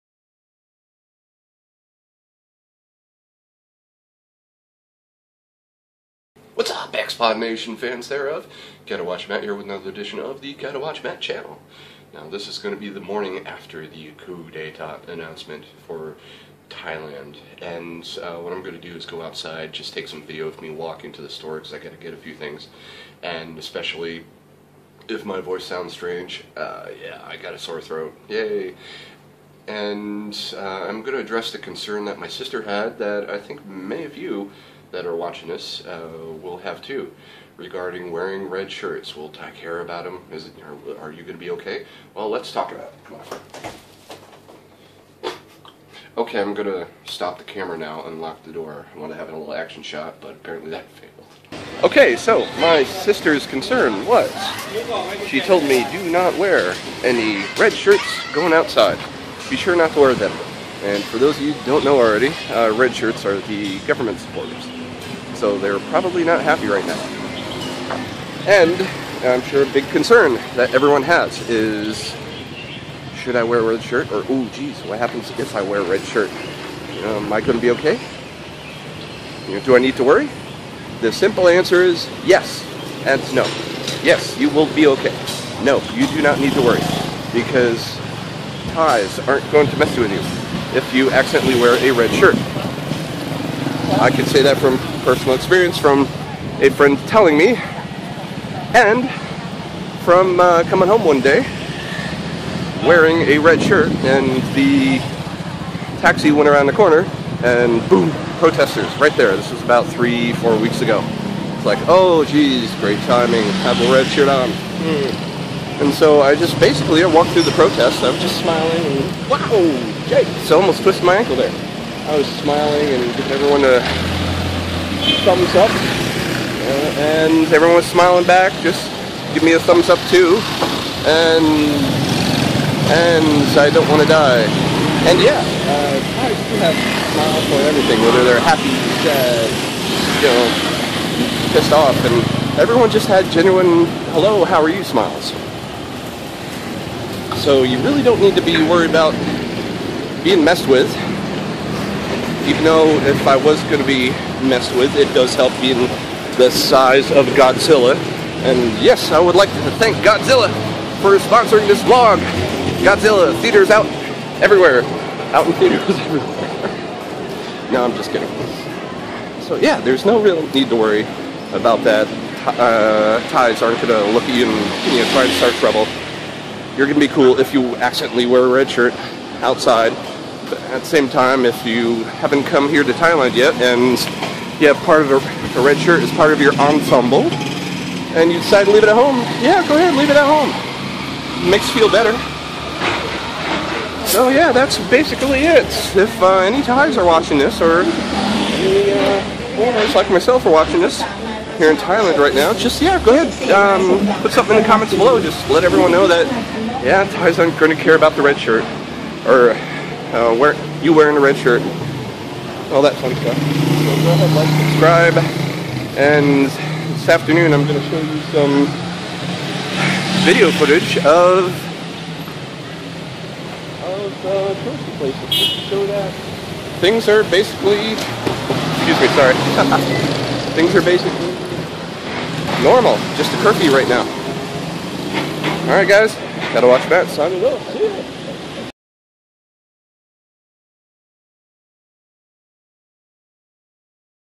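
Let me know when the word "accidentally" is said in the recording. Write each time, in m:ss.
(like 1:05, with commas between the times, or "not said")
1:31, 2:57.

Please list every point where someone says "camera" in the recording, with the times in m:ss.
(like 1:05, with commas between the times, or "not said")
0:47.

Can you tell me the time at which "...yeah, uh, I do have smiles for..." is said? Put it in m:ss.
2:15.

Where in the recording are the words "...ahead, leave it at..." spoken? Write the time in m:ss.
3:09.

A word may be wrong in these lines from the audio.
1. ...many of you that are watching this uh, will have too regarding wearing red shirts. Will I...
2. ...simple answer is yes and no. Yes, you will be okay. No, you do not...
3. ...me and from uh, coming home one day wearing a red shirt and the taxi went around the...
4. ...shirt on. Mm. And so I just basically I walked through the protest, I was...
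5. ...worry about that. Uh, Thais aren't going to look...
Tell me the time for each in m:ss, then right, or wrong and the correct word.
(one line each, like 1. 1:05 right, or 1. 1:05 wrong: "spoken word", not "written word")
1. 0:33 right
2. 1:21 right
3. 1:37 right
4. 1:54 right
5. 2:50 right.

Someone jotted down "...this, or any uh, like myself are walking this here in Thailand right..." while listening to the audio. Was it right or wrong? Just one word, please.
wrong.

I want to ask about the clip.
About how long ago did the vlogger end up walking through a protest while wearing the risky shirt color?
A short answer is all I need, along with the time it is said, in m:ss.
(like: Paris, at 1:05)
3 to 4 weeks, at 1:49.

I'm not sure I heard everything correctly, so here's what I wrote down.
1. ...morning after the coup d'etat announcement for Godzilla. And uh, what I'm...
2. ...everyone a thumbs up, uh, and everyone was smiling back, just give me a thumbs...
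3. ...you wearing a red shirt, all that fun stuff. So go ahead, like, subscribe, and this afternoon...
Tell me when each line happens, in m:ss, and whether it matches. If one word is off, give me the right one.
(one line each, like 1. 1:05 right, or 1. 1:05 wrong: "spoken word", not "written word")
1. 0:12 wrong: "Thailand", not "Godzilla"
2. 2:03 right
3. 3:30 right.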